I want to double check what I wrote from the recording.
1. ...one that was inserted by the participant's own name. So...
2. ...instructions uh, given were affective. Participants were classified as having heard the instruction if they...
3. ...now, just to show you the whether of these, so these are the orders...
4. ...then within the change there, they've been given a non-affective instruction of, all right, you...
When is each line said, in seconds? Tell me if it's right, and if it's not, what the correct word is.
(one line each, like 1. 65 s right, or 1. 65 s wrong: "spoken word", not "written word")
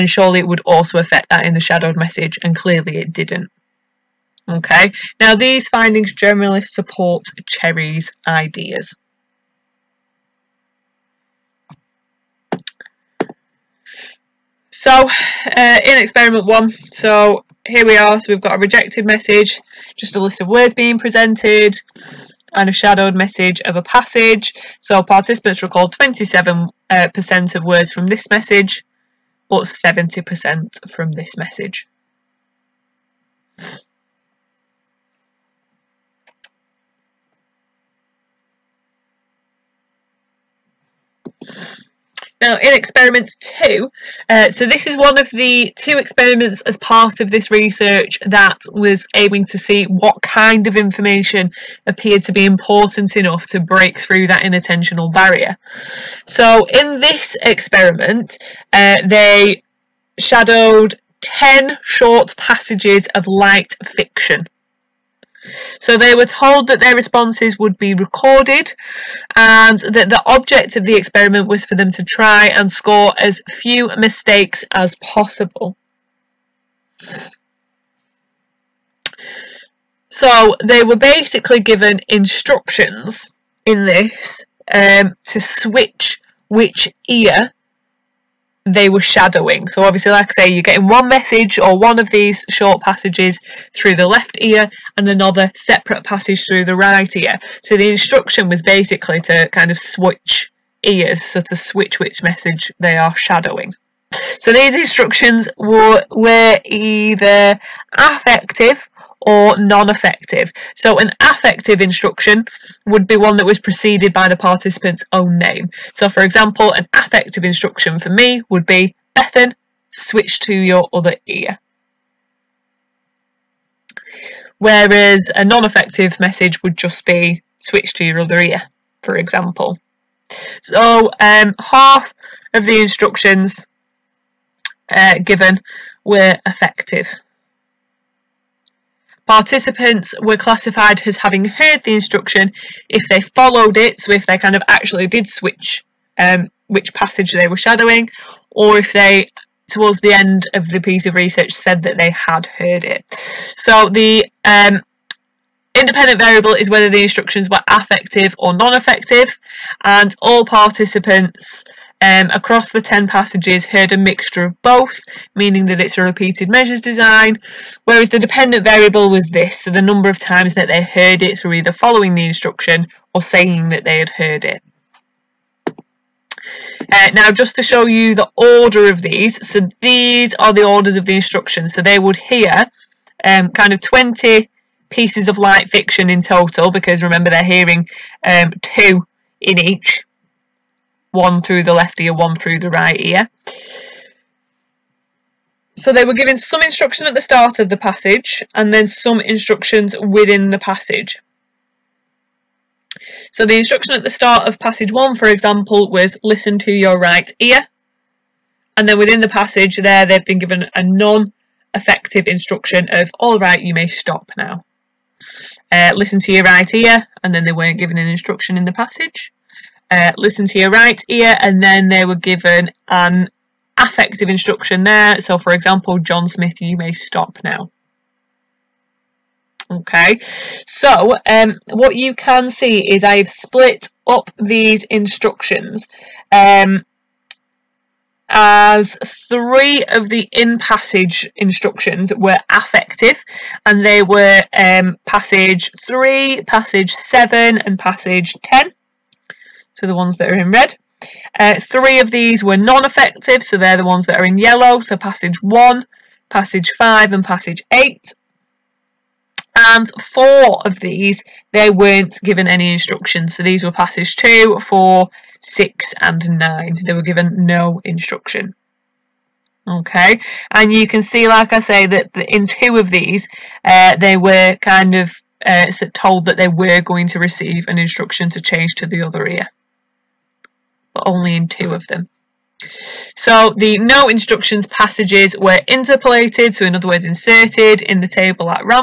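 1. 113 s wrong: "preceded", not "inserted"
2. 132 s right
3. 177 s wrong: "order", not "whether"
4. 208 s wrong: "passage", not "change".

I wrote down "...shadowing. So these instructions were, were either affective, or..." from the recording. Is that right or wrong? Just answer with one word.
right.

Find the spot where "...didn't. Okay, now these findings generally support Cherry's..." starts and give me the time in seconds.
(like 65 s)
3 s.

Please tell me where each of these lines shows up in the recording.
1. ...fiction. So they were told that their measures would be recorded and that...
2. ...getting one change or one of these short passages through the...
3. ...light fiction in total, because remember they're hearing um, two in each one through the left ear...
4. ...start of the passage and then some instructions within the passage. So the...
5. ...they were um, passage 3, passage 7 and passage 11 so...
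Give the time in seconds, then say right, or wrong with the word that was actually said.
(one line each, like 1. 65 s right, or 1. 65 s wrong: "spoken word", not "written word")
1. 63 s wrong: "responses", not "measures"
2. 90 s wrong: "message", not "change"
3. 185 s right
4. 197 s right
5. 243 s wrong: "10", not "11".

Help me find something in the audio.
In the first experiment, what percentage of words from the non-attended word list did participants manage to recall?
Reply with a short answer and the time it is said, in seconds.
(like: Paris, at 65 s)
27%, at 25 s.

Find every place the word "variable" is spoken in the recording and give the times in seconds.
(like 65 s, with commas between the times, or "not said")
156 s, 168 s.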